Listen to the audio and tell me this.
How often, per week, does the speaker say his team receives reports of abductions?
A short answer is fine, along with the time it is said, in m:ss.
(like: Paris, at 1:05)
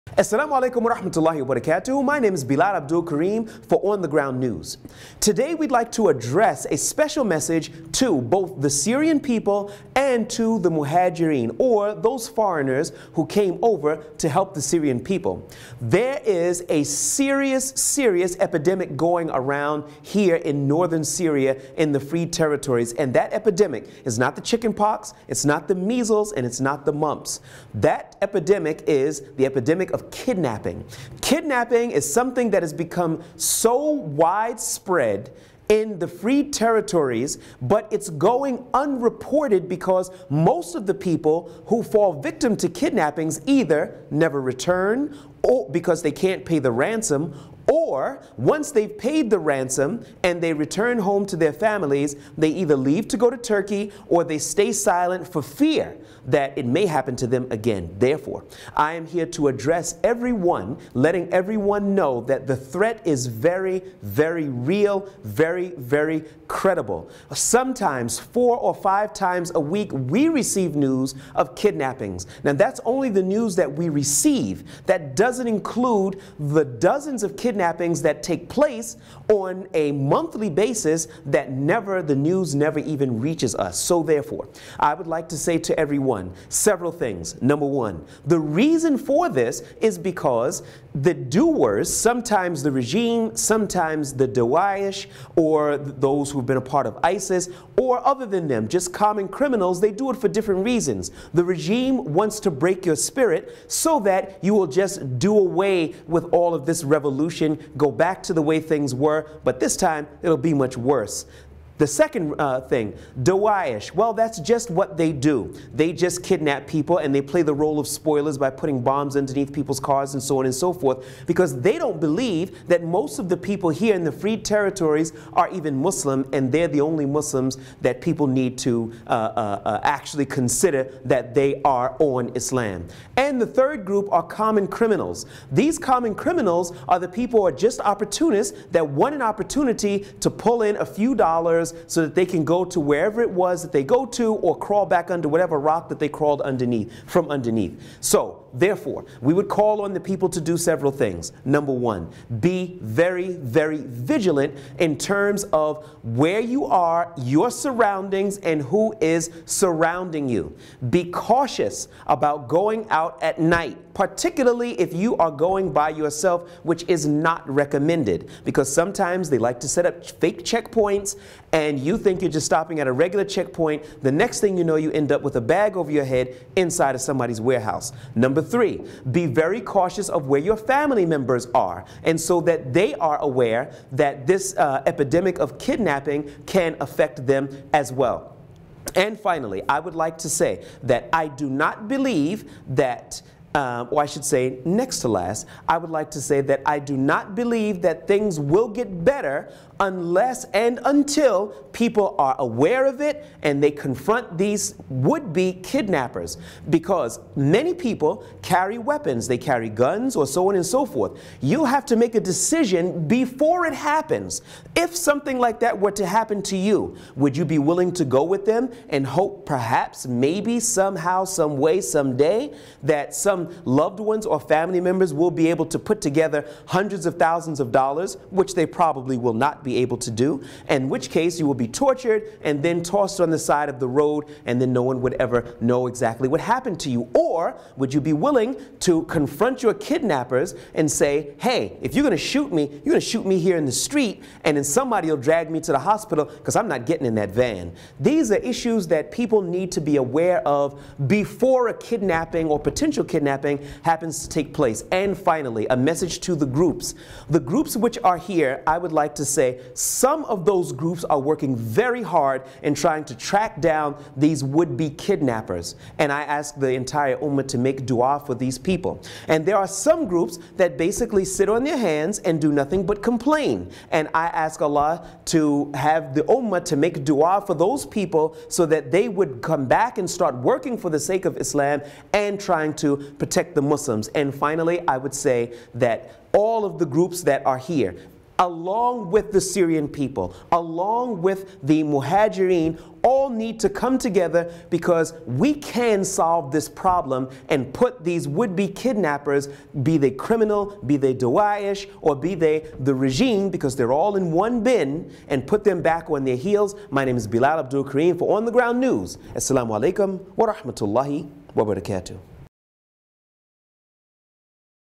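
4 or 5 times a week, at 1:08.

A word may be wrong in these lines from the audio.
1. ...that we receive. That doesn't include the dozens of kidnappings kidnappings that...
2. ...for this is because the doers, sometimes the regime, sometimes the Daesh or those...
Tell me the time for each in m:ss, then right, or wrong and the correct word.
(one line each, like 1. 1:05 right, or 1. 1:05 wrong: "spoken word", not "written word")
1. 1:13 right
2. 1:28 right.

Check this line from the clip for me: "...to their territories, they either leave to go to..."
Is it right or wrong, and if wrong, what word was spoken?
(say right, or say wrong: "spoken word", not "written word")
wrong: "families", not "territories".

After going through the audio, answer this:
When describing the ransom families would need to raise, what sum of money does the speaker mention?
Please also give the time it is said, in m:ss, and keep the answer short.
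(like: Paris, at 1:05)
Hundreds of thousands of dollars, at 3:46.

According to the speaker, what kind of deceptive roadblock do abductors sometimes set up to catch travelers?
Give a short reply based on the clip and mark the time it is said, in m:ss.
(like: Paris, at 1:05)
Fake checkpoints, at 2:50.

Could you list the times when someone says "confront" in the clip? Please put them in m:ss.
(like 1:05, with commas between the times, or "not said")
3:23, 3:59.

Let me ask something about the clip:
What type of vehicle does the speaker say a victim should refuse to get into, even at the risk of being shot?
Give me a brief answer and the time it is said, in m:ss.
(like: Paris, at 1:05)
Van, at 4:07.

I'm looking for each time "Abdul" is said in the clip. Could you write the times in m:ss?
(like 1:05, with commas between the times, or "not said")
0:02, 5:07.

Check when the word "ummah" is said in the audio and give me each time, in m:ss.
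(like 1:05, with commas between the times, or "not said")
4:27, 4:36.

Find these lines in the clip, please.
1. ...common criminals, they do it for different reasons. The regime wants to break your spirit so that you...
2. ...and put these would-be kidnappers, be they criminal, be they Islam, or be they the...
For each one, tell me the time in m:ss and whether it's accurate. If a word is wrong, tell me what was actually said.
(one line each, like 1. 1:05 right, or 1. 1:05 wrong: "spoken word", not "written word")
1. 1:38 right
2. 4:57 wrong: "Daesh", not "Islam".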